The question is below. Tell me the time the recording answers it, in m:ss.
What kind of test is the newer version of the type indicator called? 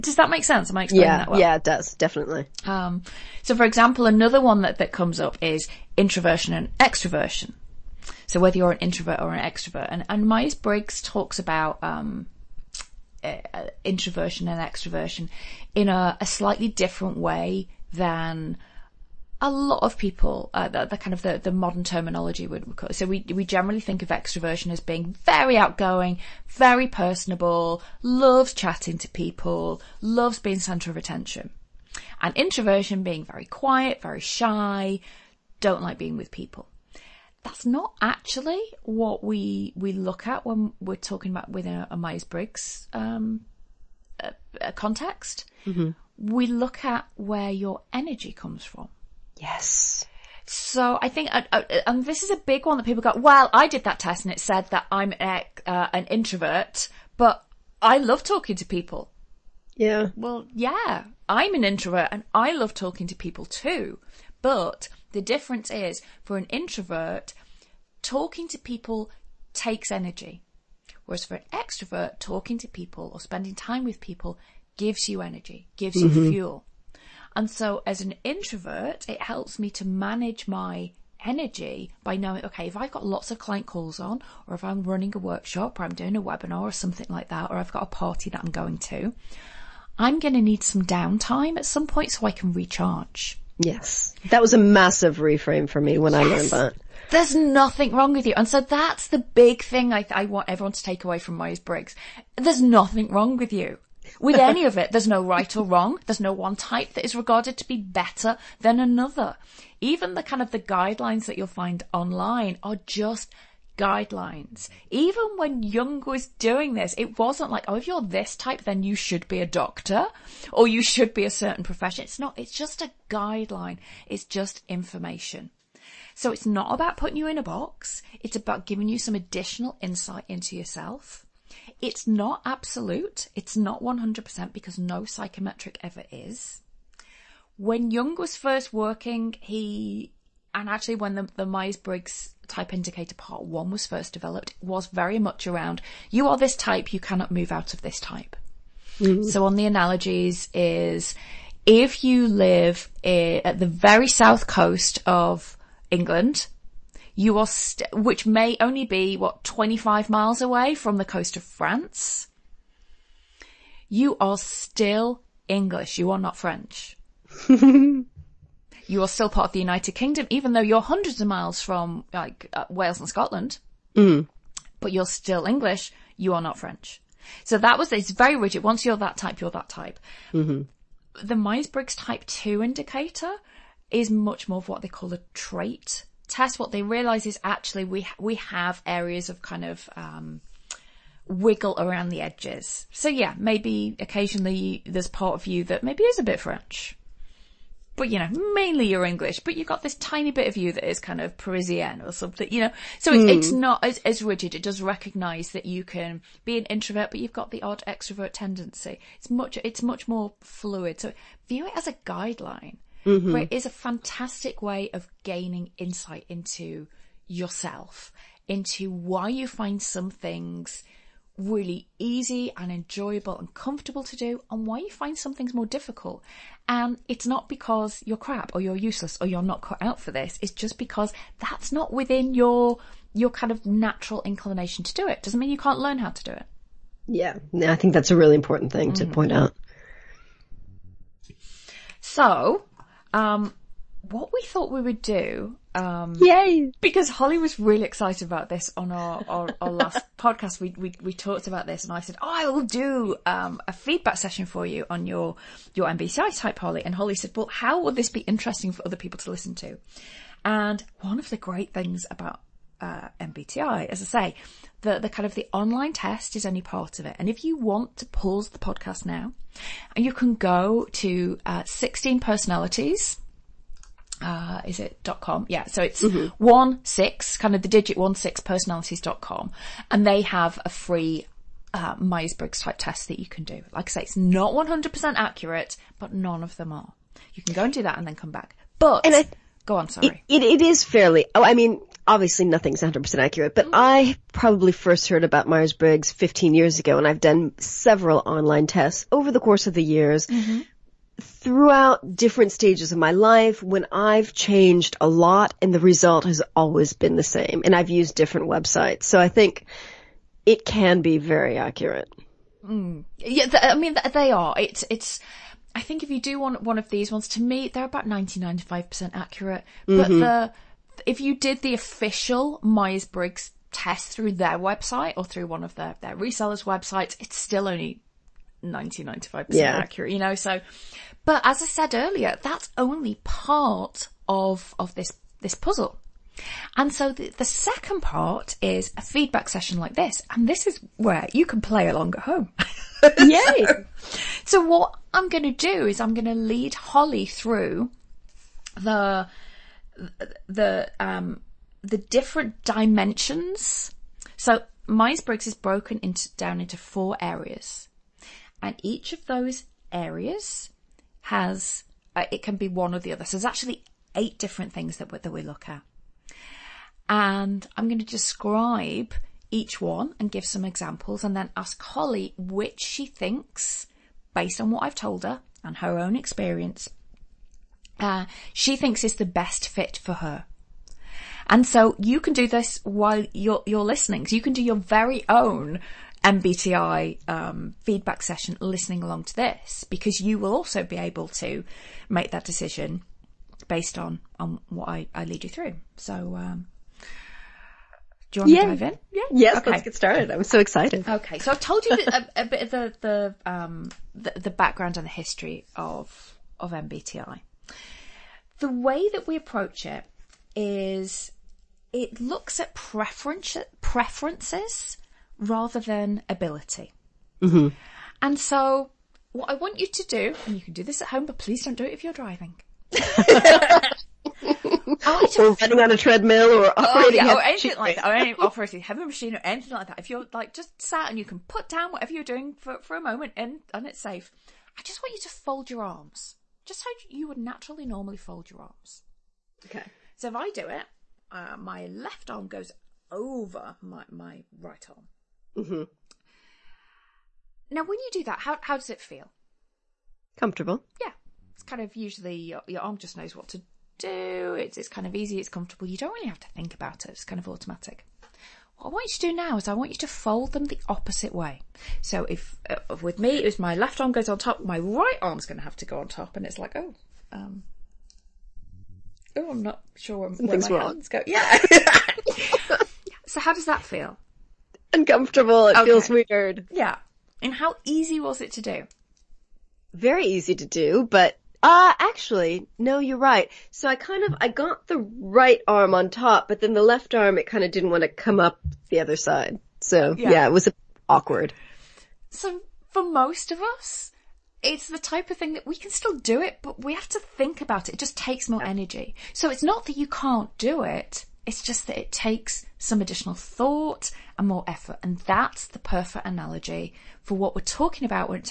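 3:05.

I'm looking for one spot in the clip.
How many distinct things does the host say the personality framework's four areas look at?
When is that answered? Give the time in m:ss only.
6:04.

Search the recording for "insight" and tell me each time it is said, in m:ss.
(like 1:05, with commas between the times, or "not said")
2:09, 3:35.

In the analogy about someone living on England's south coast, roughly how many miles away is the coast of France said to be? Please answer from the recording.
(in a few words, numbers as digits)
25.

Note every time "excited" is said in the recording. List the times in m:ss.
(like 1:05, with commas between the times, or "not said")
4:07, 6:40.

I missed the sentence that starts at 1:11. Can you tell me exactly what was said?
Whereas for an extrovert, talking to people or spending time with people gives you energy, gives mm-hmm.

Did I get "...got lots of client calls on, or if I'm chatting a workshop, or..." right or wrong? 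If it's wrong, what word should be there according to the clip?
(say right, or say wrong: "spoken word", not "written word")
wrong: "running", not "chatting".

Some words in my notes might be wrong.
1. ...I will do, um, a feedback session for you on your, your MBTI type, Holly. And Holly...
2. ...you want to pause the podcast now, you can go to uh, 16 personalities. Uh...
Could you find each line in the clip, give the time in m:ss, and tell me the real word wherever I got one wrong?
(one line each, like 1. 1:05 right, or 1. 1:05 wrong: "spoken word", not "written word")
1. 4:12 right
2. 4:27 right.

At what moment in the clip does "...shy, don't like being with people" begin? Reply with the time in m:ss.
0:34.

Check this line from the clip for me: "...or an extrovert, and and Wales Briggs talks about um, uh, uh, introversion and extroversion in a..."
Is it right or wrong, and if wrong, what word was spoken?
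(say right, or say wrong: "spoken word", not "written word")
wrong: "Myers", not "Wales".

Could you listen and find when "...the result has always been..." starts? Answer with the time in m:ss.
5:05.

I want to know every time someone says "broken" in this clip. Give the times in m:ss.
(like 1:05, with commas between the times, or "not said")
5:55.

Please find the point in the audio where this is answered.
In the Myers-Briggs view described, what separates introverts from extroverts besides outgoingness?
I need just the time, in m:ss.
0:47.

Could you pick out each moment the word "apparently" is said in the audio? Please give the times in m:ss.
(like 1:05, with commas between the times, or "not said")
not said.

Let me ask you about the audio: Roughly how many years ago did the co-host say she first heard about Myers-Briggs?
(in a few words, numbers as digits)
15.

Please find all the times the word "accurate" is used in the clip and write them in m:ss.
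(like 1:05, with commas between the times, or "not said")
4:45, 4:53, 5:11, 5:19, 5:29.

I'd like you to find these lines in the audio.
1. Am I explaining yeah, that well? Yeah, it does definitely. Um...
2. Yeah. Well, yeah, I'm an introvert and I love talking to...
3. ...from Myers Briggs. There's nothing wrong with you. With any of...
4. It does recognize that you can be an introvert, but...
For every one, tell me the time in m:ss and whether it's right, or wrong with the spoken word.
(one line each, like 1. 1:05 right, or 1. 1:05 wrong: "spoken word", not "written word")
1. 0:00 right
2. 0:59 right
3. 1:41 right
4. 3:24 right.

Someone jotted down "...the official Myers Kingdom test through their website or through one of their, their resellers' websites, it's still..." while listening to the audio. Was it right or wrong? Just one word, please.
wrong.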